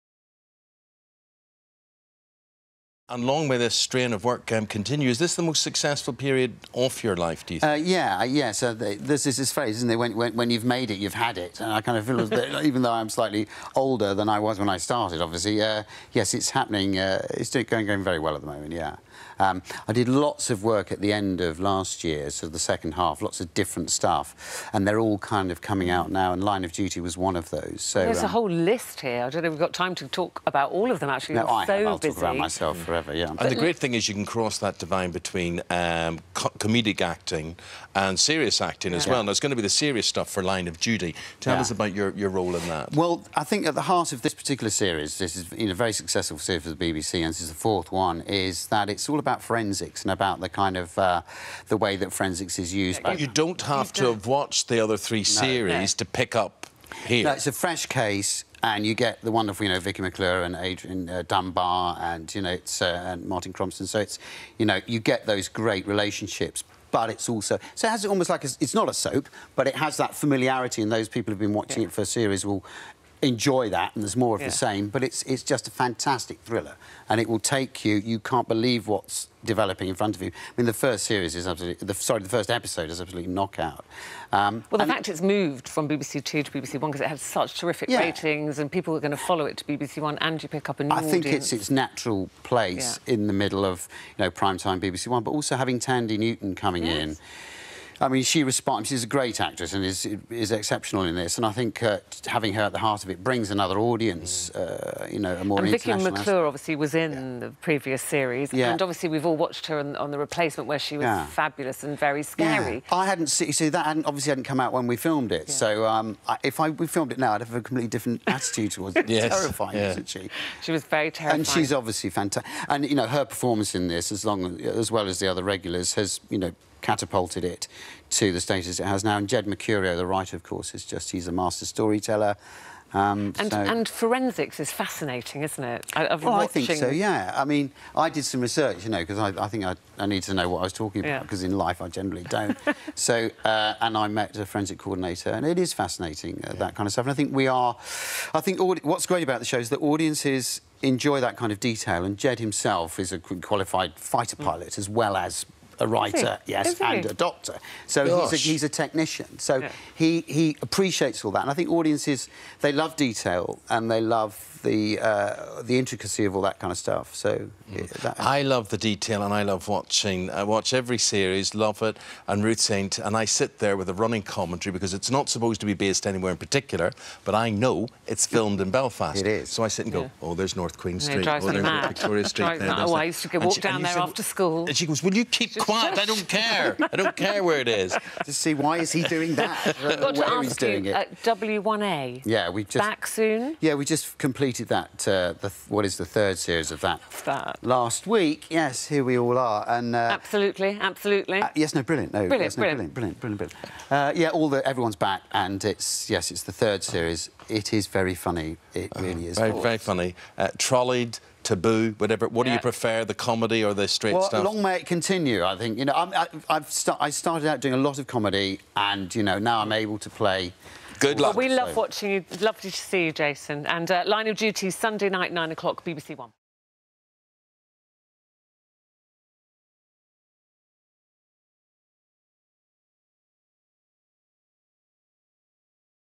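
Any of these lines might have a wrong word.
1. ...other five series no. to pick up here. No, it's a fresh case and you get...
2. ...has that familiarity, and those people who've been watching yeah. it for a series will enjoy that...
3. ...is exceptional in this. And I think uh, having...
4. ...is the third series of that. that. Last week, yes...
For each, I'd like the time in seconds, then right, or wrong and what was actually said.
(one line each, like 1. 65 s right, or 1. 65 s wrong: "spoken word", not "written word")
1. 54 s wrong: "three", not "five"
2. 69 s right
3. 100 s right
4. 195 s right.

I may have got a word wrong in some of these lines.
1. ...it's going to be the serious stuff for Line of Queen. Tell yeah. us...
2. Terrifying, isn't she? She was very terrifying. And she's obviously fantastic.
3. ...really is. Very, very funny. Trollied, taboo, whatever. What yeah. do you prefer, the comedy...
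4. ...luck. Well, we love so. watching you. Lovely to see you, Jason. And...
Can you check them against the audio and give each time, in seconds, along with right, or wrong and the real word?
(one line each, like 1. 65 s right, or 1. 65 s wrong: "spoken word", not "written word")
1. 39 s wrong: "Duty", not "Queen"
2. 119 s right
3. 208 s right
4. 221 s right.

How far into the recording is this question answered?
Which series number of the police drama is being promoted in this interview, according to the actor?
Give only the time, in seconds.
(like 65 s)
47 s.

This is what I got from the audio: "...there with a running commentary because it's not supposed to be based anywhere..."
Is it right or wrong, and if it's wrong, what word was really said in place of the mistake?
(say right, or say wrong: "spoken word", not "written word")
right.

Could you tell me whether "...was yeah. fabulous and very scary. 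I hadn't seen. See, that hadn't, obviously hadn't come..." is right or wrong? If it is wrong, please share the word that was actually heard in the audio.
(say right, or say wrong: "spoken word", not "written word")
right.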